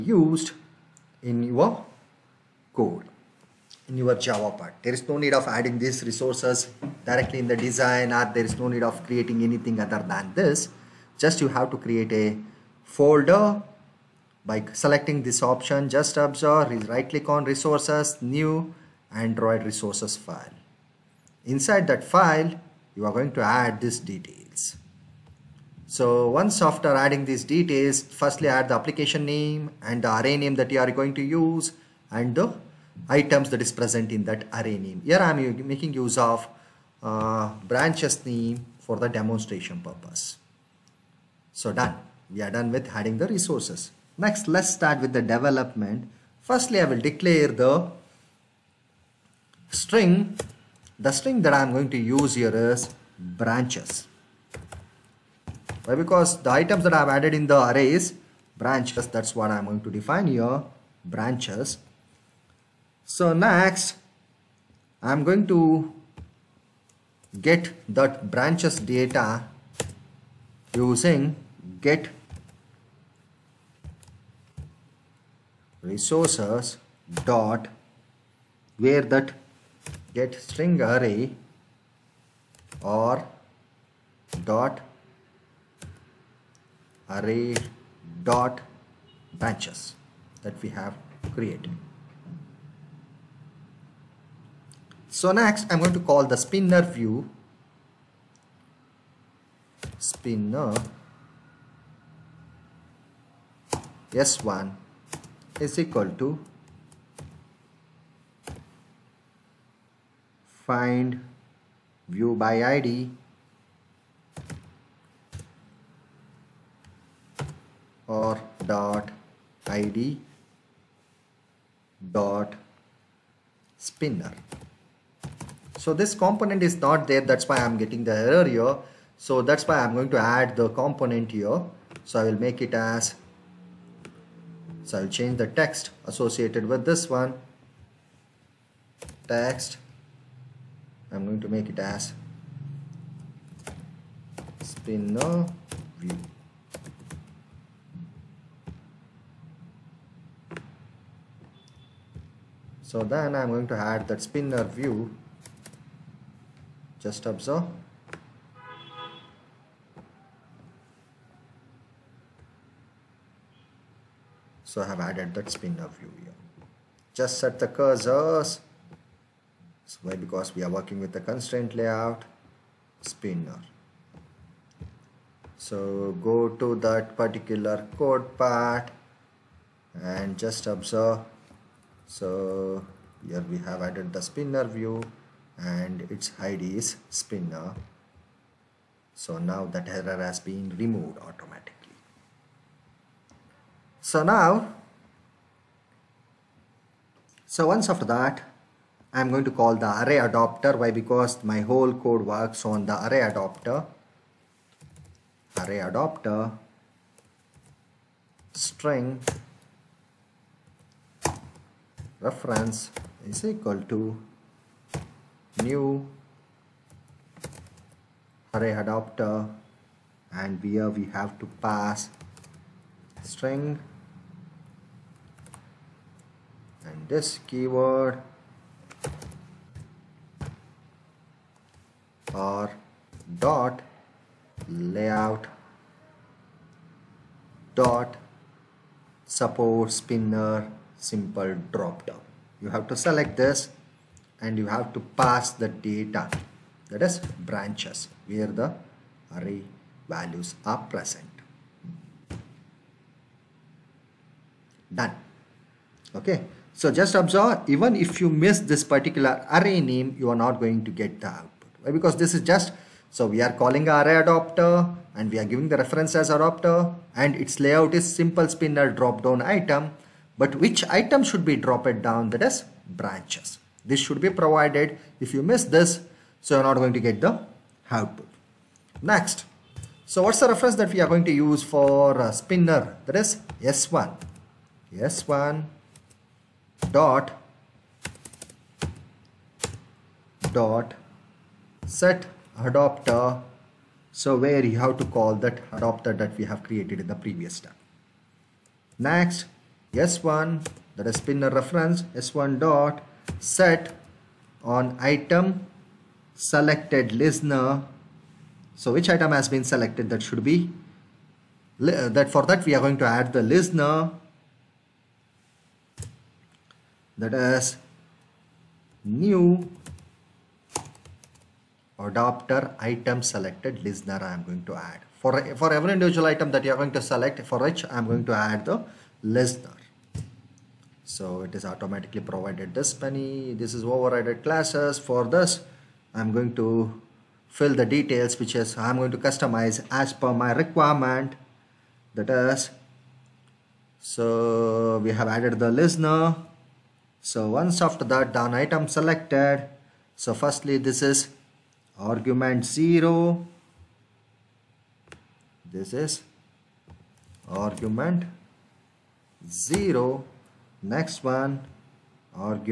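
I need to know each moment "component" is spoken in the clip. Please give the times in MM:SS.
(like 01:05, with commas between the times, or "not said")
02:06, 02:10.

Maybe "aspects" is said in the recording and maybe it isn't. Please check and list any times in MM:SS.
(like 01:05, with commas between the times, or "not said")
not said.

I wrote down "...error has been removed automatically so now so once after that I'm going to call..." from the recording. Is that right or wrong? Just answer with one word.
right.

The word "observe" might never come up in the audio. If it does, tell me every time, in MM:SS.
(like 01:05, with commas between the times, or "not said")
00:16, 02:37, 03:00, 04:17.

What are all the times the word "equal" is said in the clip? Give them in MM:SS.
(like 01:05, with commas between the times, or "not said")
01:45, 03:33.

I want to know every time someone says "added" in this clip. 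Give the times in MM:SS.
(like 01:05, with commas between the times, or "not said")
00:57, 02:44, 03:03, 05:45.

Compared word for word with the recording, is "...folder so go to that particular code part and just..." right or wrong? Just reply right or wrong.
wrong.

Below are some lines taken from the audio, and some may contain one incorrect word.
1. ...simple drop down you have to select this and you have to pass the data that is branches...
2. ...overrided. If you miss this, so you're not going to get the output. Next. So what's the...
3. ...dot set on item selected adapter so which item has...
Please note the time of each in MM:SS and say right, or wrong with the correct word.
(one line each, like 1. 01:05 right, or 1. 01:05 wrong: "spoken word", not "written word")
1. 04:00 right
2. 04:34 wrong: "provided", not "overrided"
3. 05:02 wrong: "listener", not "adapter".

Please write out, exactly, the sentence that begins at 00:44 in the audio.
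Next, let's start with the development.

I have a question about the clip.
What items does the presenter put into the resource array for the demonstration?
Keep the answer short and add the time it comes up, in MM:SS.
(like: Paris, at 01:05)
Branches name, at 00:37.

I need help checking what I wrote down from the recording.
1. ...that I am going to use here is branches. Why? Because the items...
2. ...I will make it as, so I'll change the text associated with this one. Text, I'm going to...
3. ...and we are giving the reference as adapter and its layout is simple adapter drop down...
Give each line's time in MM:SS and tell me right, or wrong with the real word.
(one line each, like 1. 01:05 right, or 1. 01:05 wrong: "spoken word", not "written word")
1. 00:51 right
2. 02:12 right
3. 04:25 wrong: "spinner", not "adapter".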